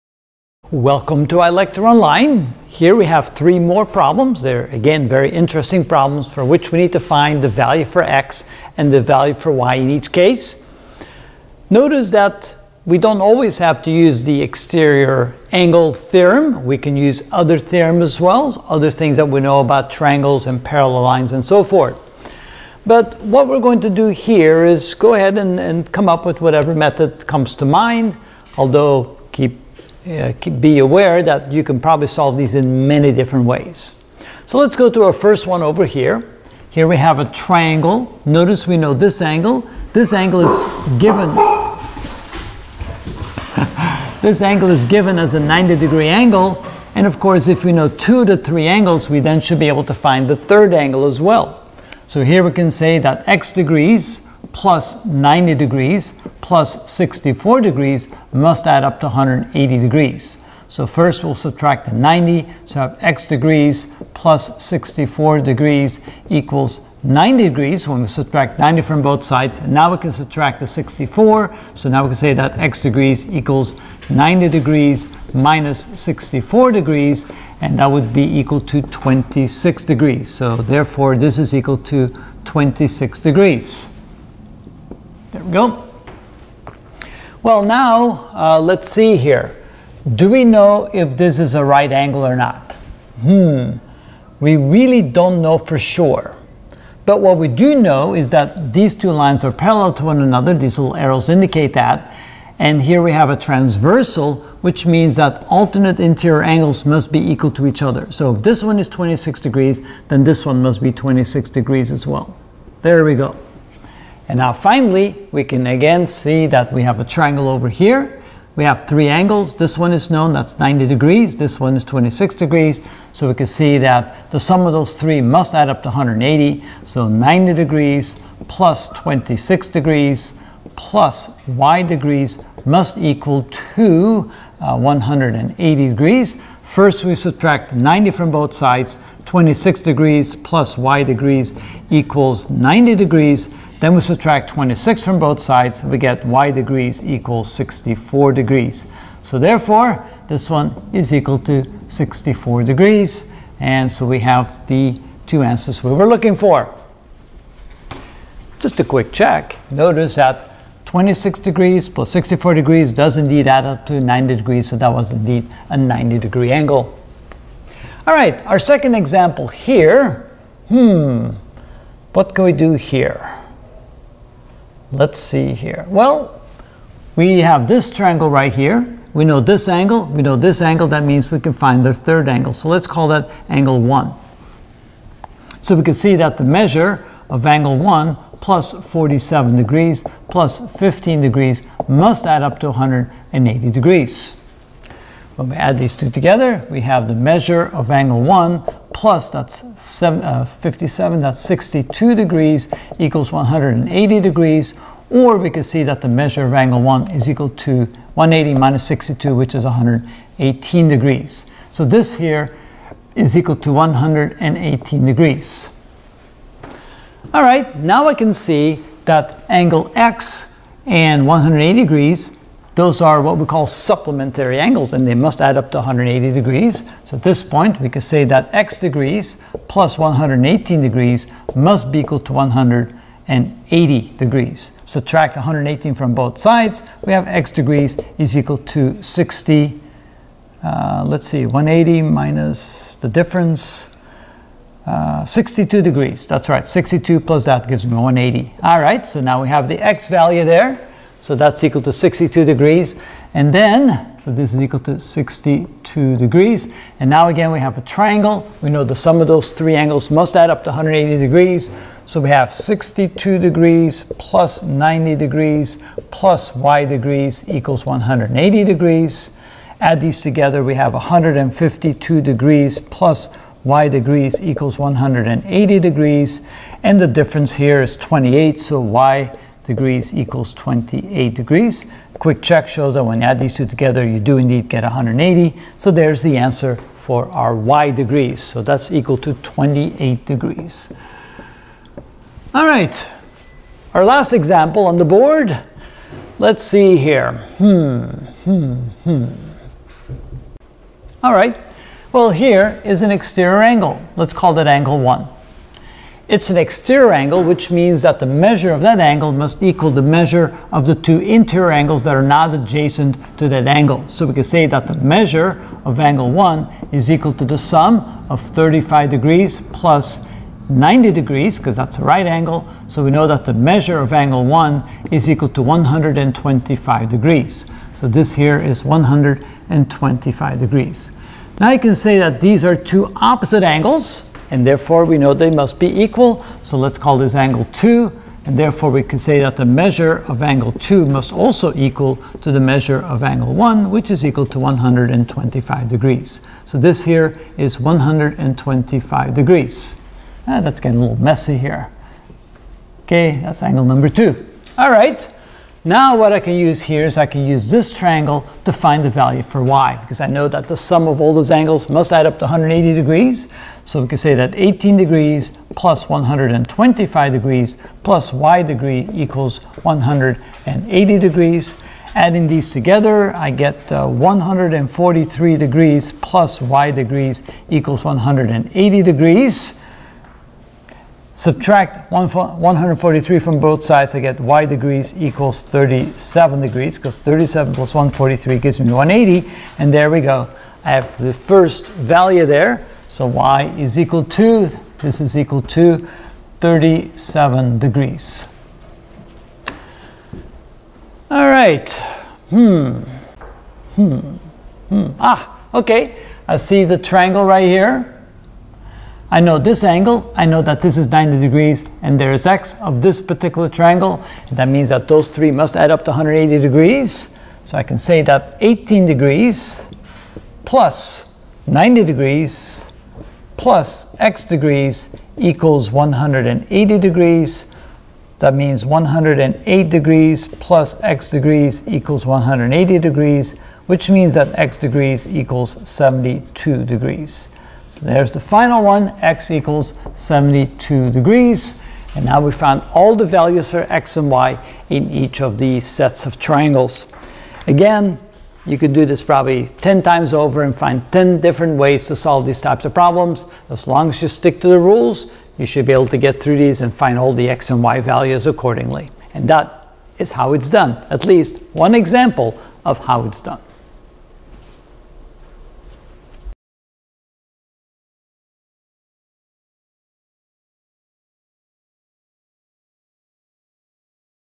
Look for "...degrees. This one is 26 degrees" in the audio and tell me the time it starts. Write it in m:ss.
2:00.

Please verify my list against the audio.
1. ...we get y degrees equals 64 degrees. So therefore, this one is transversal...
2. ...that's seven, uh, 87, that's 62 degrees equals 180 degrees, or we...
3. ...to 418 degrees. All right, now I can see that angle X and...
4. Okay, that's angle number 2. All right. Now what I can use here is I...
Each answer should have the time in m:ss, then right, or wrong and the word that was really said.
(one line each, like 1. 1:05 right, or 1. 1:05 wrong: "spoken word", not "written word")
1. 2:25 wrong: "equal", not "transversal"
2. 3:19 wrong: "57", not "87"
3. 3:33 wrong: "118", not "418"
4. 5:53 right.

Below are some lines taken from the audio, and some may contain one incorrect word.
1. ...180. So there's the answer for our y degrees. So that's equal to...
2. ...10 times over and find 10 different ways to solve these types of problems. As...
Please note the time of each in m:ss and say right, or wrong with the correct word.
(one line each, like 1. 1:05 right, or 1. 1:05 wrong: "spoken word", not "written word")
1. 4:44 right
2. 7:29 right.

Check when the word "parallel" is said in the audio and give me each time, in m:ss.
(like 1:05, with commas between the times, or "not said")
0:20, 1:39.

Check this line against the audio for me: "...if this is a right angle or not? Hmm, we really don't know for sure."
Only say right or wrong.
right.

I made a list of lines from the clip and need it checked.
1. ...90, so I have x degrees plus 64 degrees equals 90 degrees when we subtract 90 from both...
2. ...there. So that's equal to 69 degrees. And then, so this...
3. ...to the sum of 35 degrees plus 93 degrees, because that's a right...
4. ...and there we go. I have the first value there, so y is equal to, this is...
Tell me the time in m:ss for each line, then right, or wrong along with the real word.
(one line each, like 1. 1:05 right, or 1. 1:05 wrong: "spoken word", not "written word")
1. 1:01 right
2. 4:10 wrong: "62", not "69"
3. 5:17 wrong: "90", not "93"
4. 6:29 right.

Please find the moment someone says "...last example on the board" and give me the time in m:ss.
4:54.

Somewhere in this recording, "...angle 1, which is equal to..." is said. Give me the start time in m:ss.
5:43.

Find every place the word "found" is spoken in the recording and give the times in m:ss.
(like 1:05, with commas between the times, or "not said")
7:22.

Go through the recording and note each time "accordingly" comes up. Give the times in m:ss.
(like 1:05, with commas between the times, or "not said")
7:38.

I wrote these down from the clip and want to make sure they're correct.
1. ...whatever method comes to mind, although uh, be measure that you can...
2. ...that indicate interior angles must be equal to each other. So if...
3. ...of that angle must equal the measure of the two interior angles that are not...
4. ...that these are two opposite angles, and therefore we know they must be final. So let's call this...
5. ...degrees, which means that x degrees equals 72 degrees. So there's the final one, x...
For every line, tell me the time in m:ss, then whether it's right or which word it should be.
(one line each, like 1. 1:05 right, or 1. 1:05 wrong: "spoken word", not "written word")
1. 0:26 wrong: "aware", not "measure"
2. 1:45 wrong: "alternate", not "indicate"
3. 5:08 right
4. 5:32 wrong: "equal", not "final"
5. 7:12 right.